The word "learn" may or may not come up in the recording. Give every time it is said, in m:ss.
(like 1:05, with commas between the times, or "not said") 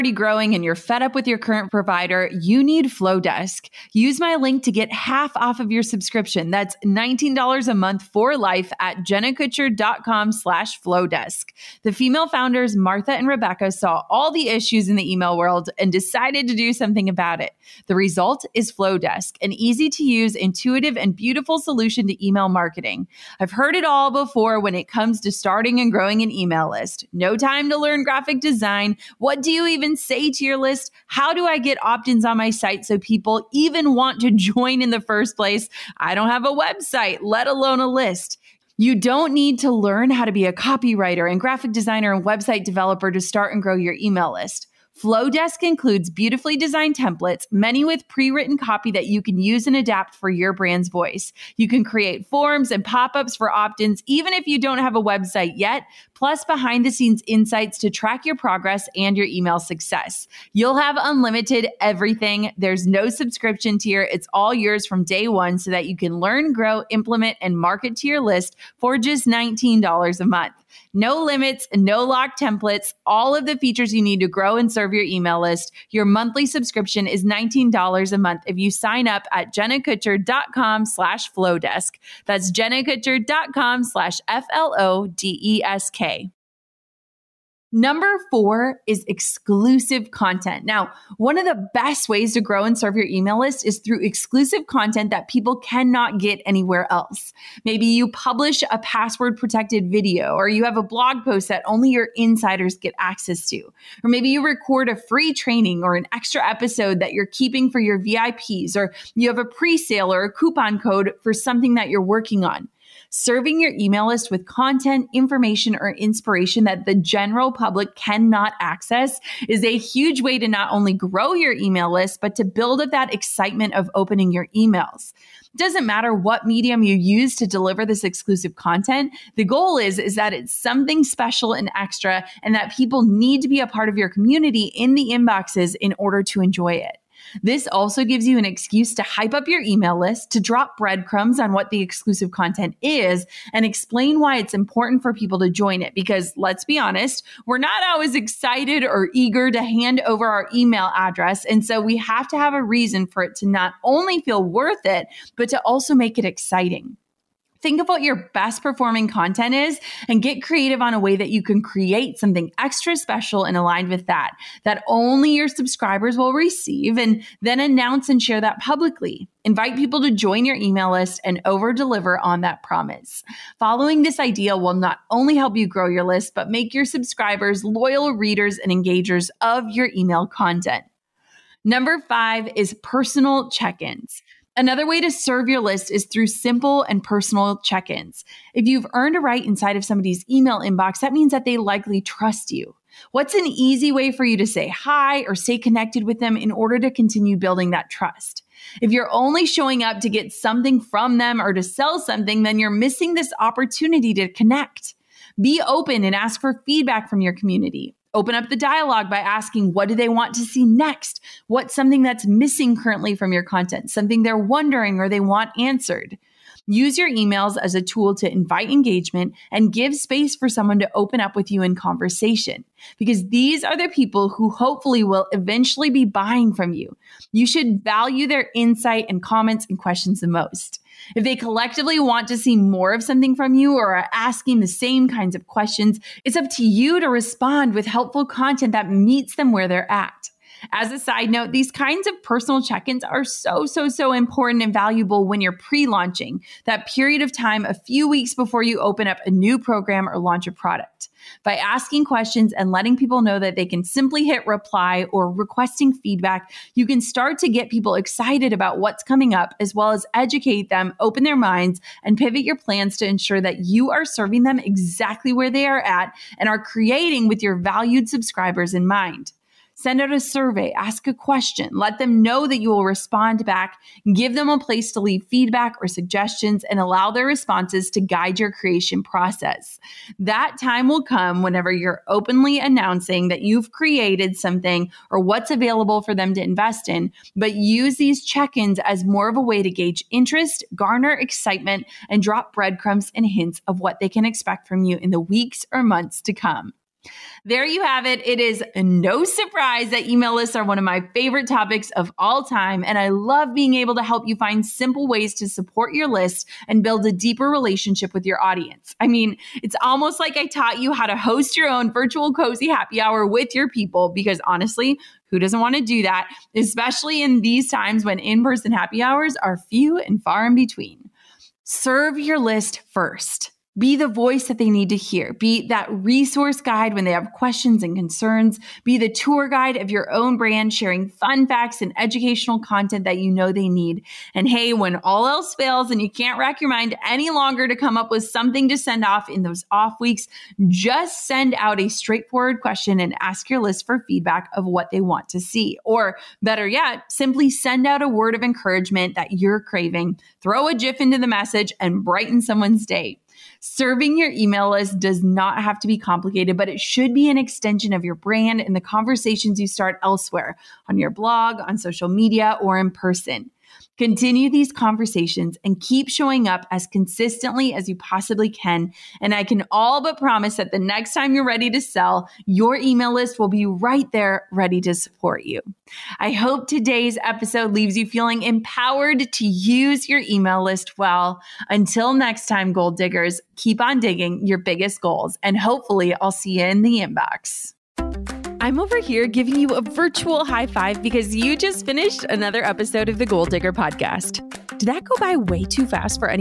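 0:27, 0:39, 1:06.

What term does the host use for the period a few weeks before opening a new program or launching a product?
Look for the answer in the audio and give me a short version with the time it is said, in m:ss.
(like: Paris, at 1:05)
pre launching, at 4:05.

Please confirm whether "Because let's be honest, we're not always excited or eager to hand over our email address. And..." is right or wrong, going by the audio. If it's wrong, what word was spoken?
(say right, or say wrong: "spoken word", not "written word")
right.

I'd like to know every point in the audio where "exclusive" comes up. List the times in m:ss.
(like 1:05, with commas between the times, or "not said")
1:29, 1:34, 2:08, 2:21.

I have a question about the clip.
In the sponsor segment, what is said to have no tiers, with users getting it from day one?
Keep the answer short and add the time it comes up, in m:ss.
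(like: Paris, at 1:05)
unlimited everything, at 1:00.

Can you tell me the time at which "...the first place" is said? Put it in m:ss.
0:34.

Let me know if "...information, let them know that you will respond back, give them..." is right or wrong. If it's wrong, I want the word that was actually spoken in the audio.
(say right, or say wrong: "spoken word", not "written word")
wrong: "question", not "information".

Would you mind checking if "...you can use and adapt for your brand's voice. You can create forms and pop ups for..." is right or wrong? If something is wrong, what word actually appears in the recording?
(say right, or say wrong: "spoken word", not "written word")
right.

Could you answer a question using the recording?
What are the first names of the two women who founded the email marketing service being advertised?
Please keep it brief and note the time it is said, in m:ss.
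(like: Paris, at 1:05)
Martha and Rebecca, at 0:12.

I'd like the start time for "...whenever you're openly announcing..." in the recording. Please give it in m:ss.
4:41.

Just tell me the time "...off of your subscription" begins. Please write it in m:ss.
0:05.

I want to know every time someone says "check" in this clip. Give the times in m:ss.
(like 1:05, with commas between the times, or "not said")
3:03, 3:07, 4:02, 4:48.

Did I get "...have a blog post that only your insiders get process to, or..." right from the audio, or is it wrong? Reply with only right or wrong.
wrong.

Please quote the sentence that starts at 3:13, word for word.
What's an easy way for you to say hi or stay connected with them in order to continue building that trust?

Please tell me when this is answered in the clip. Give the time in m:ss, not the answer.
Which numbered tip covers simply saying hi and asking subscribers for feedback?
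3:01.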